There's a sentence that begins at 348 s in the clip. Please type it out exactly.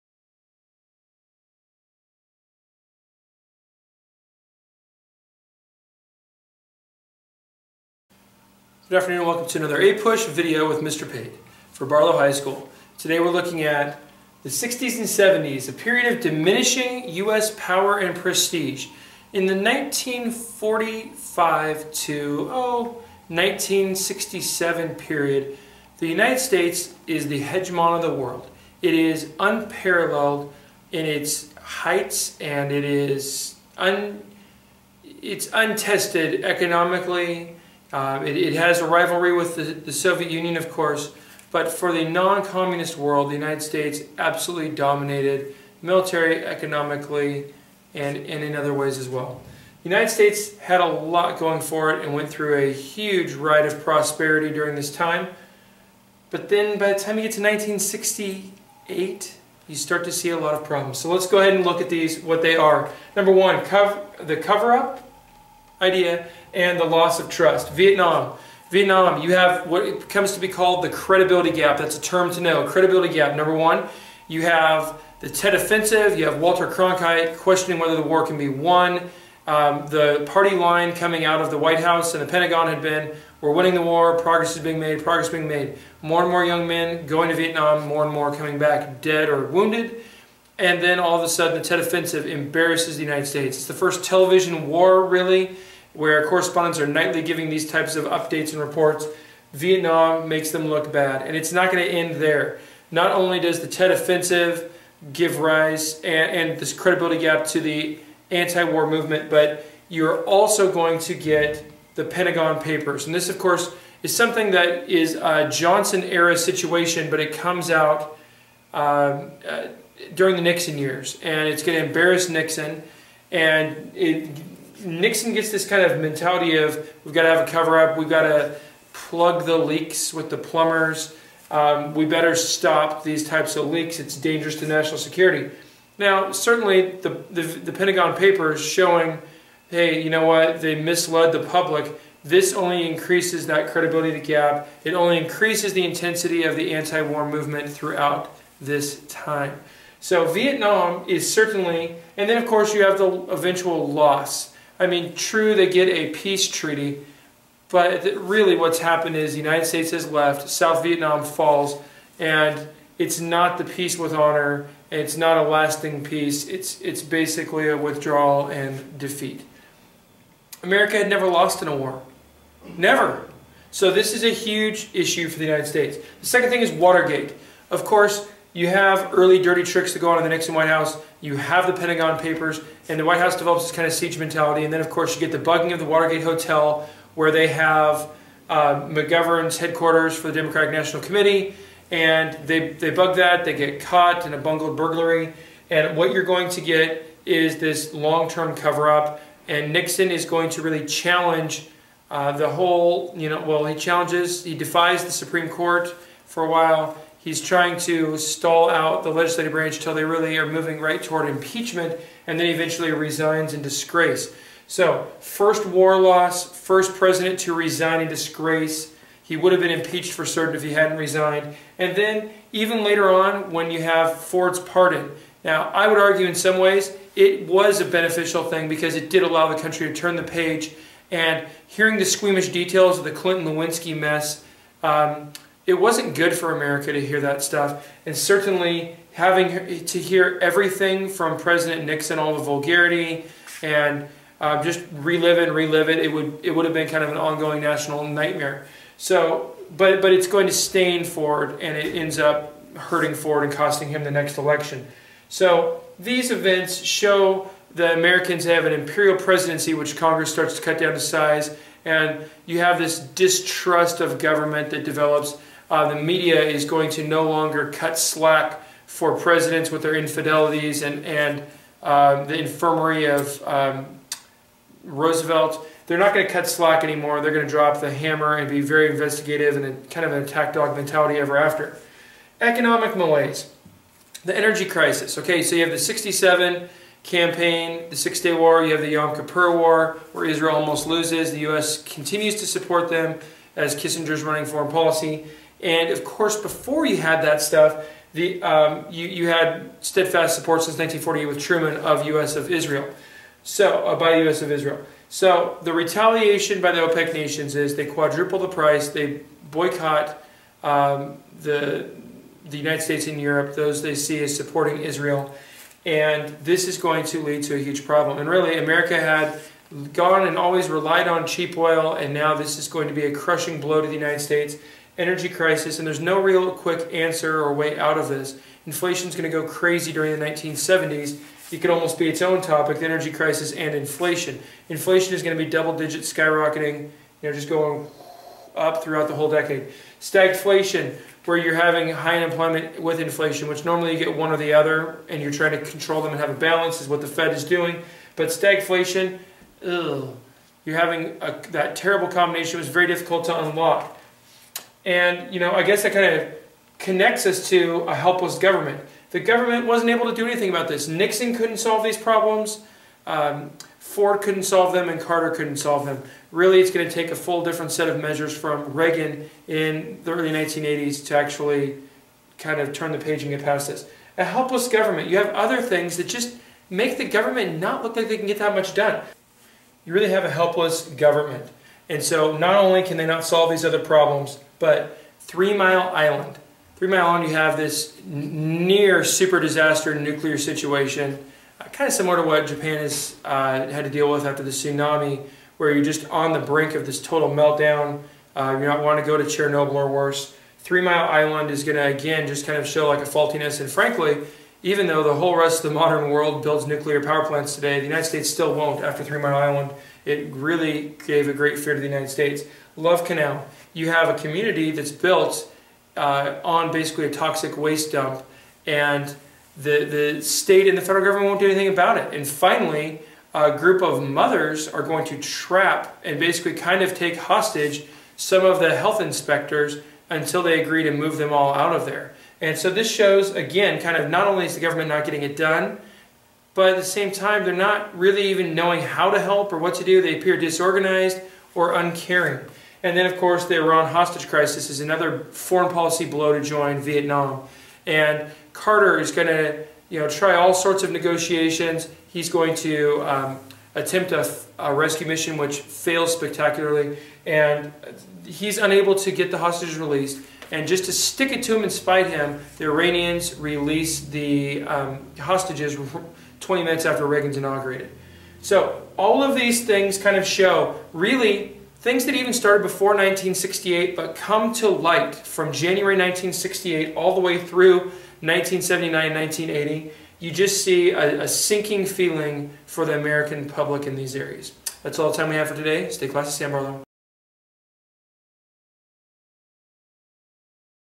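But stagflation, ugh, you're having a, that terrible combination.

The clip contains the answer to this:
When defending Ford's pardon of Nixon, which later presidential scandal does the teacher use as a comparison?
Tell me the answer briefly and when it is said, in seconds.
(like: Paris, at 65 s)
Clinton Lewinsky, at 233 s.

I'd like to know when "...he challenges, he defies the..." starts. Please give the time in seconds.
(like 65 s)
203 s.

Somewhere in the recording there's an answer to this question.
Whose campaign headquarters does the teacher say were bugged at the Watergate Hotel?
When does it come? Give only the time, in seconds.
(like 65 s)
188 s.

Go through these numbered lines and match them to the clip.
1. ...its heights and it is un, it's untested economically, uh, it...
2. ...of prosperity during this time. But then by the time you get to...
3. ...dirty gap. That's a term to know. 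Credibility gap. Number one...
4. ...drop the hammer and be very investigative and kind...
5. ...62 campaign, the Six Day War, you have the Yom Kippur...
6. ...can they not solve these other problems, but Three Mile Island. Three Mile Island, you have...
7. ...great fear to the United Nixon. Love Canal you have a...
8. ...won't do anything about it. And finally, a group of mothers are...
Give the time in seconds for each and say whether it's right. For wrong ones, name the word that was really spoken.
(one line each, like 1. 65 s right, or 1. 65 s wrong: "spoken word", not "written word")
1. 31 s right
2. 53 s right
3. 70 s wrong: "credibility", not "dirty"
4. 277 s right
5. 285 s wrong: "67", not "62"
6. 382 s right
7. 411 s wrong: "States", not "Nixon"
8. 421 s right.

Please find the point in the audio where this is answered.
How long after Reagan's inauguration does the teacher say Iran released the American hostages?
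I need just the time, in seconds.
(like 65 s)
466 s.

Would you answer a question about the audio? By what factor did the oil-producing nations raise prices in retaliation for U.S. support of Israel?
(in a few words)
quadruple.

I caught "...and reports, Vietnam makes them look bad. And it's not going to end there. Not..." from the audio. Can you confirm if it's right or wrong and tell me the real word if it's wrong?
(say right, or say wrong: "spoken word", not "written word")
right.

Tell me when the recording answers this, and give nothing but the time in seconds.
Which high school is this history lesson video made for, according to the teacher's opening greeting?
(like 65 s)
11 s.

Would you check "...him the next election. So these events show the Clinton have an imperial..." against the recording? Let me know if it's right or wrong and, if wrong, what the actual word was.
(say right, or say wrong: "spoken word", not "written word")
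wrong: "Americans", not "Clinton".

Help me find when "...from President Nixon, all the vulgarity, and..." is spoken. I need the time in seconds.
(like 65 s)
241 s.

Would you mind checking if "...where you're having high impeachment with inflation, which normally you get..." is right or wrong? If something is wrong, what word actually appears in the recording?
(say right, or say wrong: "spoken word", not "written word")
wrong: "unemployment", not "impeachment".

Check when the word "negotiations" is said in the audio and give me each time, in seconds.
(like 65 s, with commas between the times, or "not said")
450 s.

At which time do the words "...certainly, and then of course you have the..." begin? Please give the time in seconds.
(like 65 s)
151 s.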